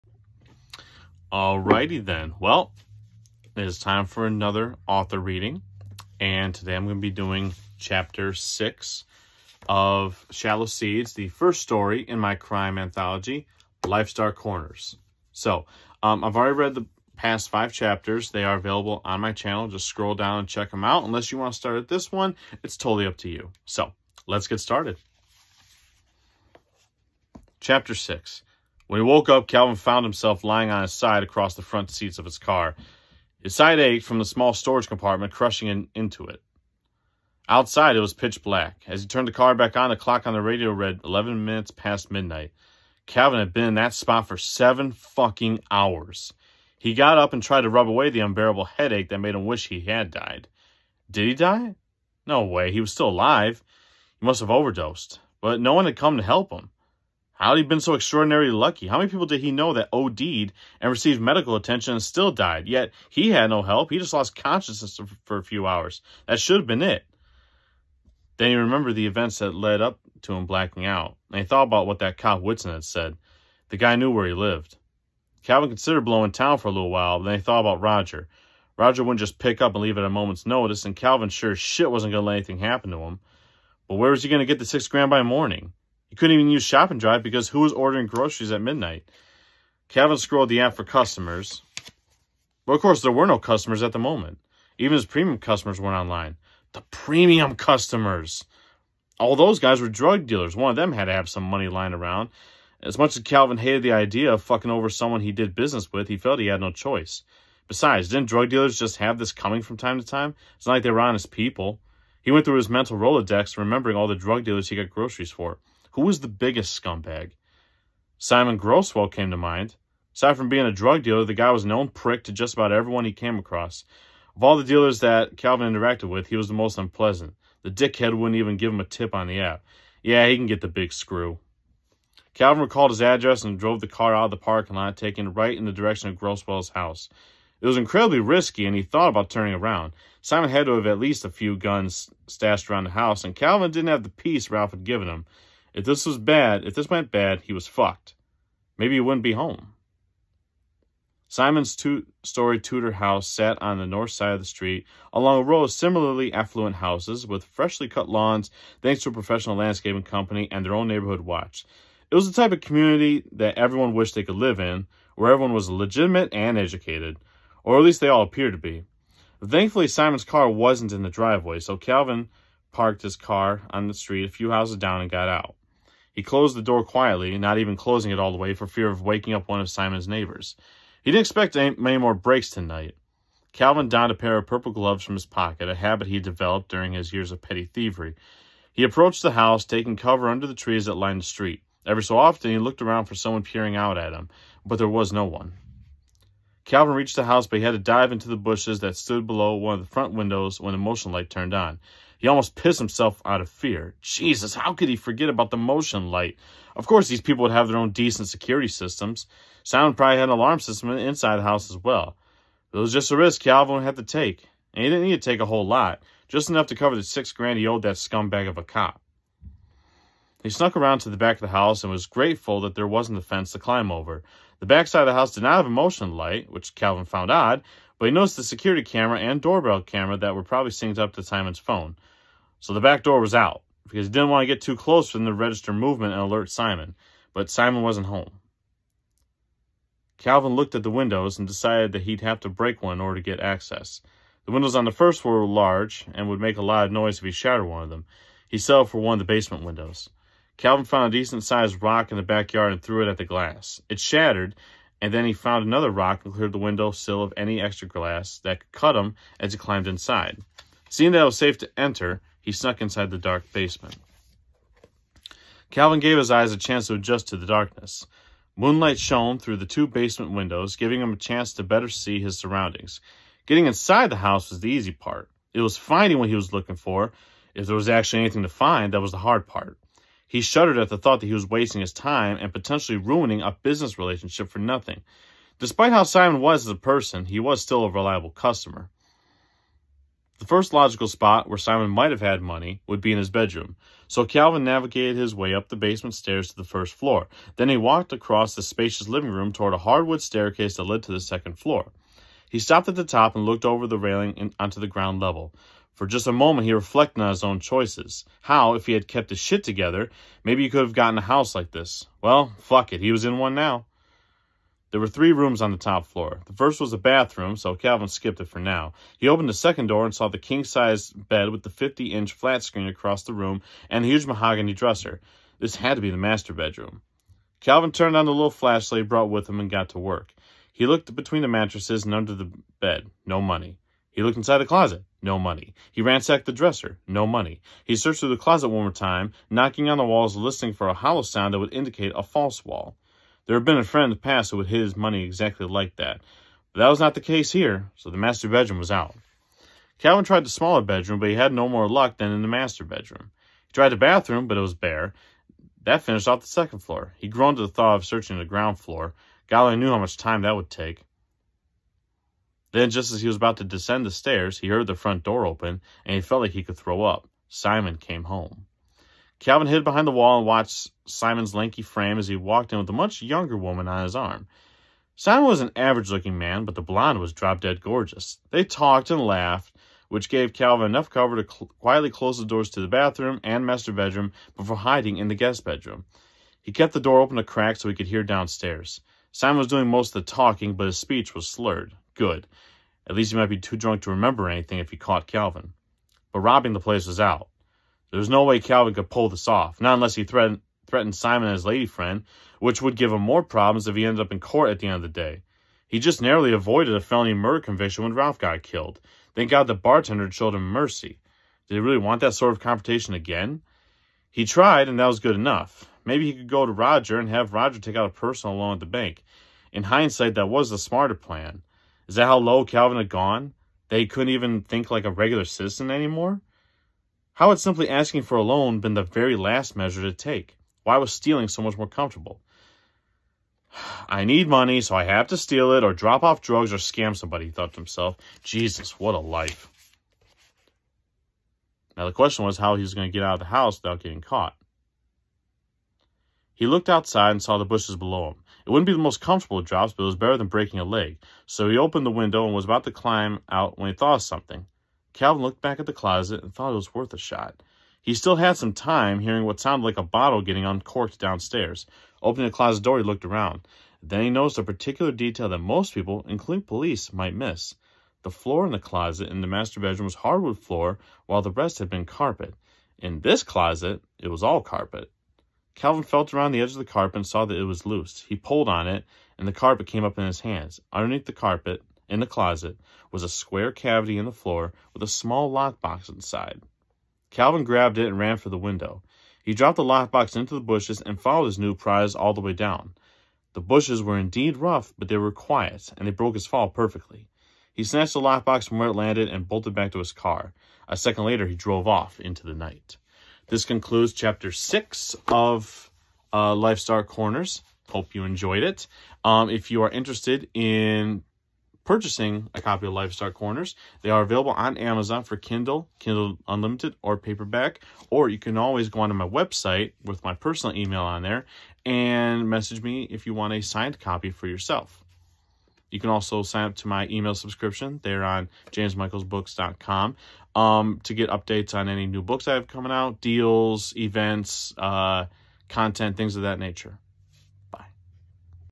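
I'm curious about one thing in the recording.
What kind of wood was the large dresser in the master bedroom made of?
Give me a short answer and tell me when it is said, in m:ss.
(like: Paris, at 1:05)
Mahogany, at 5:24.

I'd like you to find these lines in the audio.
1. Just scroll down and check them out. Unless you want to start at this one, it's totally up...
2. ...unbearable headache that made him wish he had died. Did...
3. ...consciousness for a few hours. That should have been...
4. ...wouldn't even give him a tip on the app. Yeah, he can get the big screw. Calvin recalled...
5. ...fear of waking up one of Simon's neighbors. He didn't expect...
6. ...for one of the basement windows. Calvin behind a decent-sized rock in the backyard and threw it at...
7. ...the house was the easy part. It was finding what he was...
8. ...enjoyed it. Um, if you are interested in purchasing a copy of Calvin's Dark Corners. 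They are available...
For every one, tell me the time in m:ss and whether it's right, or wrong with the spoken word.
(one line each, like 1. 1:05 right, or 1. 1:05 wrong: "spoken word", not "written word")
1. 0:19 right
2. 0:48 right
3. 1:04 right
4. 2:08 right
5. 2:58 right
6. 4:08 wrong: "found", not "behind"
7. 4:34 right
8. 8:28 wrong: "Life", not "Calvin".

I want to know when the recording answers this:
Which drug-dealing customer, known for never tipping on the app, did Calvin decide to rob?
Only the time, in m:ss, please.
1:58.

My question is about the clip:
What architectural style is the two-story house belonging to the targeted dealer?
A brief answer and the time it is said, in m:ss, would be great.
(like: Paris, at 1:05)
Tudor, at 2:32.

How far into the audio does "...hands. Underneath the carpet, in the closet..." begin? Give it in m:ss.
8:00.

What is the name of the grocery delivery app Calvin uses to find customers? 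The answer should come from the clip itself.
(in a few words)
Shop and Drive.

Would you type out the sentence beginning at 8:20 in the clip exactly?
A second later, he drove off into the night.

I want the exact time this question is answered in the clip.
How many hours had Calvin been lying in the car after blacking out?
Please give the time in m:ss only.
0:44.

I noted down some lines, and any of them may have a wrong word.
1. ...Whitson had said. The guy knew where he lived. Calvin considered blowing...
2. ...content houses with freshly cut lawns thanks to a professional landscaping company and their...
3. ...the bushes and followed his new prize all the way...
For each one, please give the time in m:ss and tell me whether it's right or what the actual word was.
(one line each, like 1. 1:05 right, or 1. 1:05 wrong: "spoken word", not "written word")
1. 1:12 right
2. 2:36 wrong: "affluent", not "content"
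3. 8:10 right.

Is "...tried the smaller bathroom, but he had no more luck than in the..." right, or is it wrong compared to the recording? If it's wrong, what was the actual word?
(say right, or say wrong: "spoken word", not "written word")
wrong: "bedroom", not "bathroom".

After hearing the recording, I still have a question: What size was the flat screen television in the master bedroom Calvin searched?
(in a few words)
50-inch.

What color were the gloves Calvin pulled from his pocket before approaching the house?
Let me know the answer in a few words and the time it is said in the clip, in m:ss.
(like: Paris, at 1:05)
Purple, at 3:04.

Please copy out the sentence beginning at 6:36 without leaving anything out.
But robbing the place was out.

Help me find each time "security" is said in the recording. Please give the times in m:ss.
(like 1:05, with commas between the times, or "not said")
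3:28, 3:48.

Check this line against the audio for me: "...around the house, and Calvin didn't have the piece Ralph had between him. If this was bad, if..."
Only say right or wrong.
wrong.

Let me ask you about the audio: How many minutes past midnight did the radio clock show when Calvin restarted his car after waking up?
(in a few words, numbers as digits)
11.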